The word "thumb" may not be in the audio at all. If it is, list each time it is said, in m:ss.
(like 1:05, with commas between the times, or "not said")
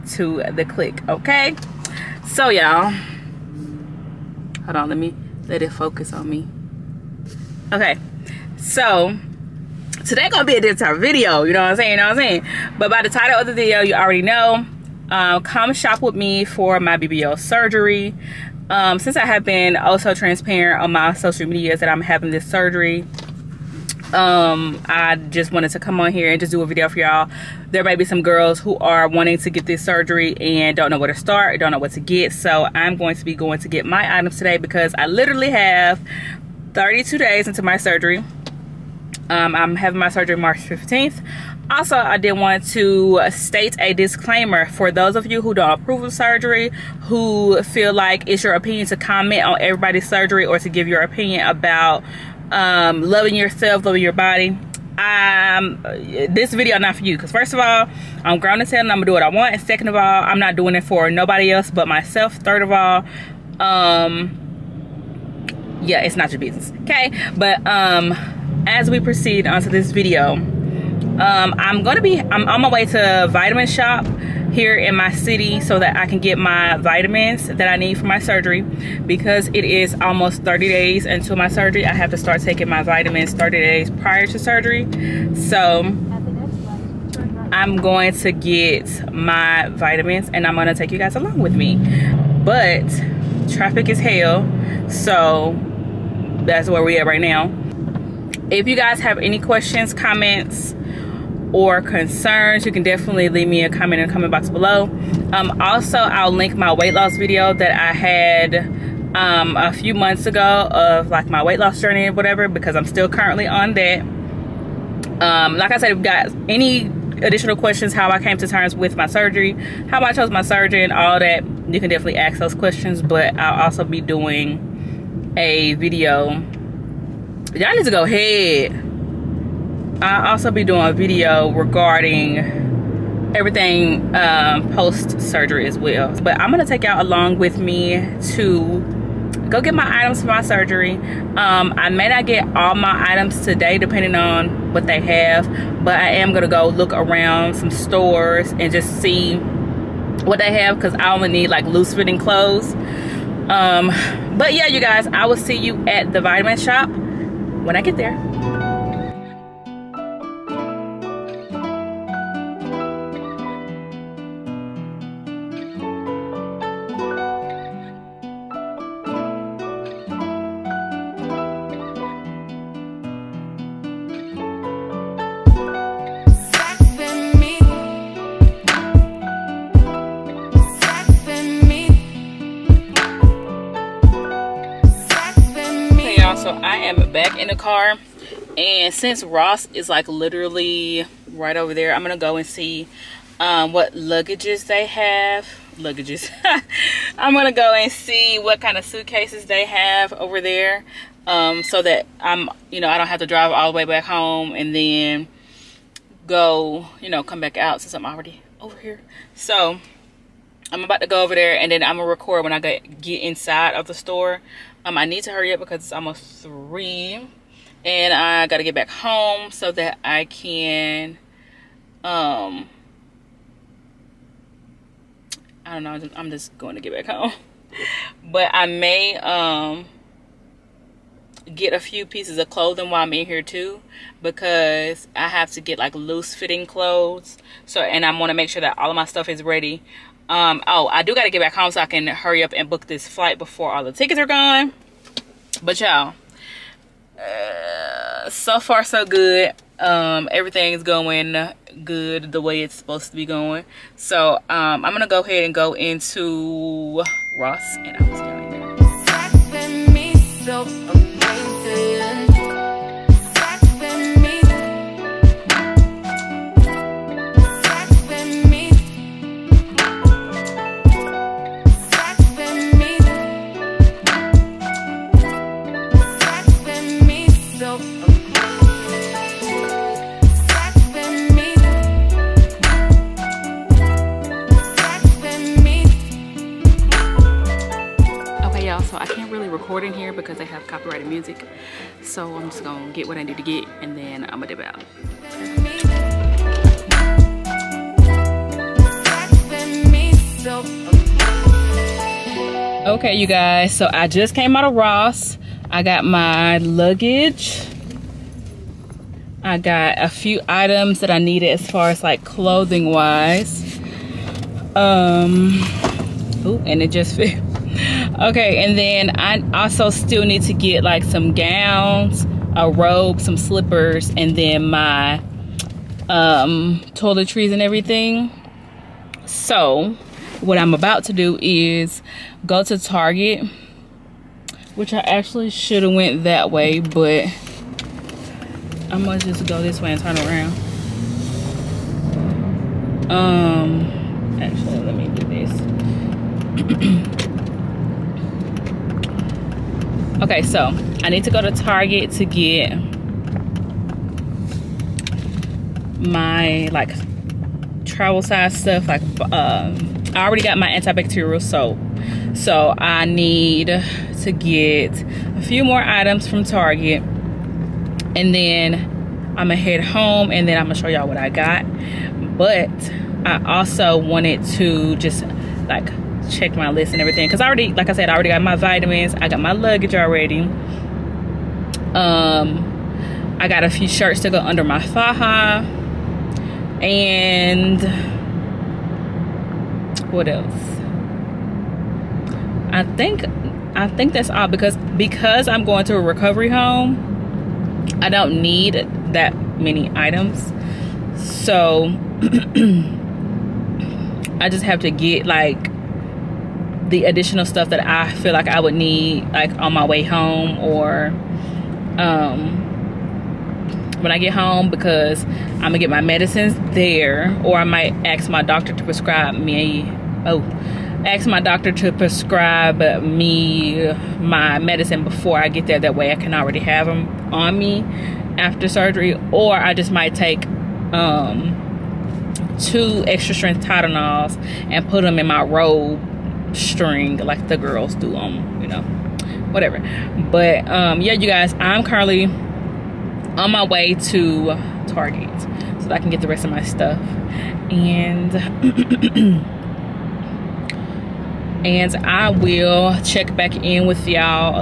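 not said.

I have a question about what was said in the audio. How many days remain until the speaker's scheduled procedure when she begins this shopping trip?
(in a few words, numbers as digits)
32.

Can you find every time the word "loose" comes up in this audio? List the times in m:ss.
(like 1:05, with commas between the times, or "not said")
2:31, 3:55.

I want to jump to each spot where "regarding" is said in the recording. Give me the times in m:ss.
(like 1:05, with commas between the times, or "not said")
2:11.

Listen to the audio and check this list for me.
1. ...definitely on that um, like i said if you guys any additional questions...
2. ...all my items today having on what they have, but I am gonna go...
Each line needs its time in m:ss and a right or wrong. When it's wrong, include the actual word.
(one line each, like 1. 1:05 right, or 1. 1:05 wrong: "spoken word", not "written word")
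1. 1:53 wrong: "currently", not "definitely"
2. 2:22 wrong: "depending", not "having".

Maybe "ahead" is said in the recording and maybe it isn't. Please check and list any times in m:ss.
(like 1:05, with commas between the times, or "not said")
2:08, 4:15.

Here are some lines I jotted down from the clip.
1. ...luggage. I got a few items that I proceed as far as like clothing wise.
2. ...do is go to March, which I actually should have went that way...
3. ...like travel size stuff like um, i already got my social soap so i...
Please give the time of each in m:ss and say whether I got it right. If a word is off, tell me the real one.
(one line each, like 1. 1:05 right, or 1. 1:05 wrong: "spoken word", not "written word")
1. 5:06 wrong: "needed", not "proceed"
2. 5:31 wrong: "Target", not "March"
3. 5:56 wrong: "antibacterial", not "social".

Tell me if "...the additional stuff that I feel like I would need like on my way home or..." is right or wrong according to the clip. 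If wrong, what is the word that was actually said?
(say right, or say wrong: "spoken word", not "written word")
right.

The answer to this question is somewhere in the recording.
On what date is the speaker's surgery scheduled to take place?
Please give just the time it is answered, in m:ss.
0:40.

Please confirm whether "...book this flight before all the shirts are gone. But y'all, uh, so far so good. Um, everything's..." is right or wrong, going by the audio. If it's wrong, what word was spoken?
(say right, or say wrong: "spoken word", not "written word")
wrong: "tickets", not "shirts".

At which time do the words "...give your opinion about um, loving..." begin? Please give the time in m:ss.
0:50.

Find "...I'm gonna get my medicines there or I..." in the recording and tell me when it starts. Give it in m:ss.
6:55.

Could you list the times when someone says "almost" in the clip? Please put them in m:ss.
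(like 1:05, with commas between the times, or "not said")
1:20, 3:35.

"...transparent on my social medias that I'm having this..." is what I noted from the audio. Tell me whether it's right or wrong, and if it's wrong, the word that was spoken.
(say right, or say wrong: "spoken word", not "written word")
right.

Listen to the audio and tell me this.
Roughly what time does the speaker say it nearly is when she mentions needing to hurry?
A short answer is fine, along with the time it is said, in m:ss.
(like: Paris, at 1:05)
3, at 3:36.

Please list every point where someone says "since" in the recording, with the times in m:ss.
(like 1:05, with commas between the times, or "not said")
0:18, 3:08, 3:27.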